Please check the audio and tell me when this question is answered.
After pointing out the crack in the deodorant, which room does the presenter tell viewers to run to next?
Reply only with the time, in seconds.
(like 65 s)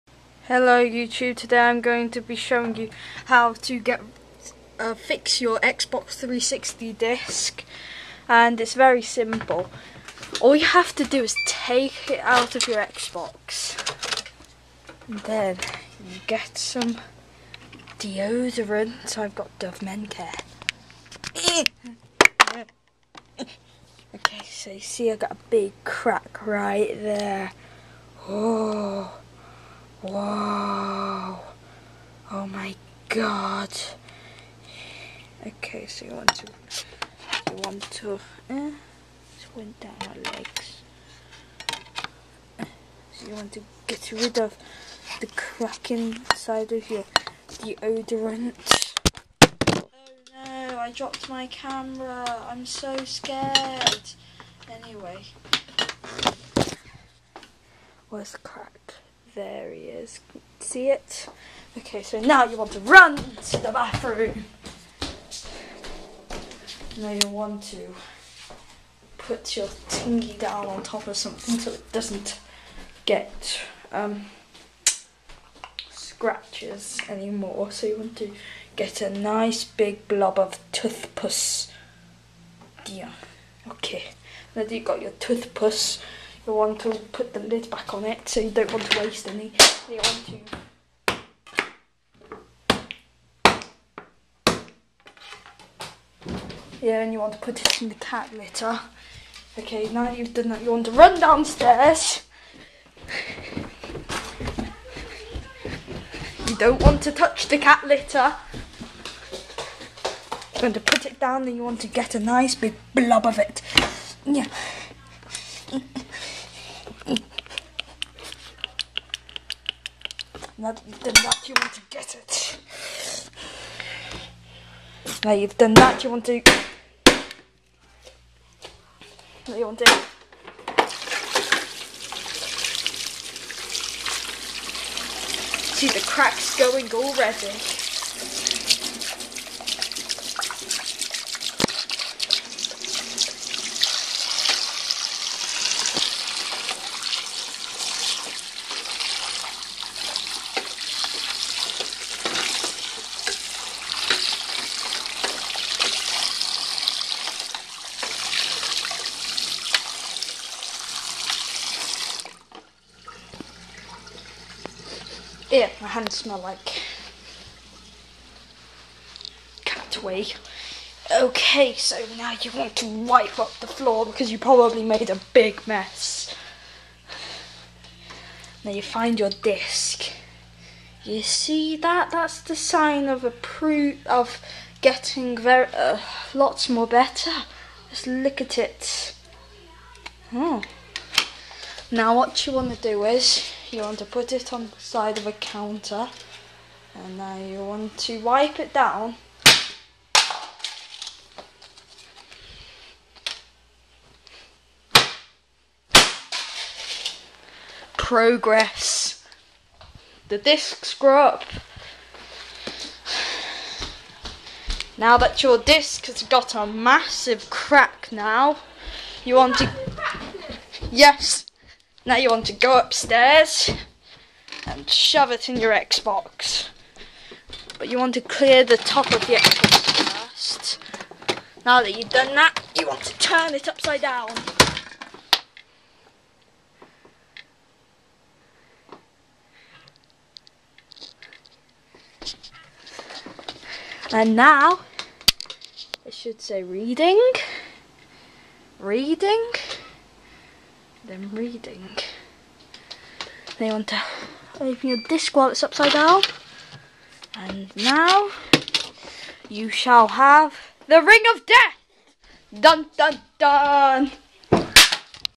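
63 s.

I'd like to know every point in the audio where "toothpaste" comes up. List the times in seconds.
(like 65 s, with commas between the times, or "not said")
80 s, 85 s.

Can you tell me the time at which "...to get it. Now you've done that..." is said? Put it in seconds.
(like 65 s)
121 s.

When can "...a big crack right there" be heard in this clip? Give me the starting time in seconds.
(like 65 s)
25 s.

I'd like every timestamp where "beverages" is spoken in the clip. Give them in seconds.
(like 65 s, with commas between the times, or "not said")
not said.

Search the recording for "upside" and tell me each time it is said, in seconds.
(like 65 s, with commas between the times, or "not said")
233 s, 255 s.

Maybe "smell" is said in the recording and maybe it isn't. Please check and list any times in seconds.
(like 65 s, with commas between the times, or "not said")
166 s.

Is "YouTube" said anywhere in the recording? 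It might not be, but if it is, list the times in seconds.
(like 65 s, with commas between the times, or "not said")
0 s.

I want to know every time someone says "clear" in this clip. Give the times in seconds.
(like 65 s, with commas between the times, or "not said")
228 s.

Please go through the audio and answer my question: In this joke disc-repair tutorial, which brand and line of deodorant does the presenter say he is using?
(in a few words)
Dove Men Care.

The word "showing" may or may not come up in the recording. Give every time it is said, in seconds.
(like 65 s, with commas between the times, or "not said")
2 s.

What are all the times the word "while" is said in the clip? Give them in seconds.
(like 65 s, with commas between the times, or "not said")
255 s.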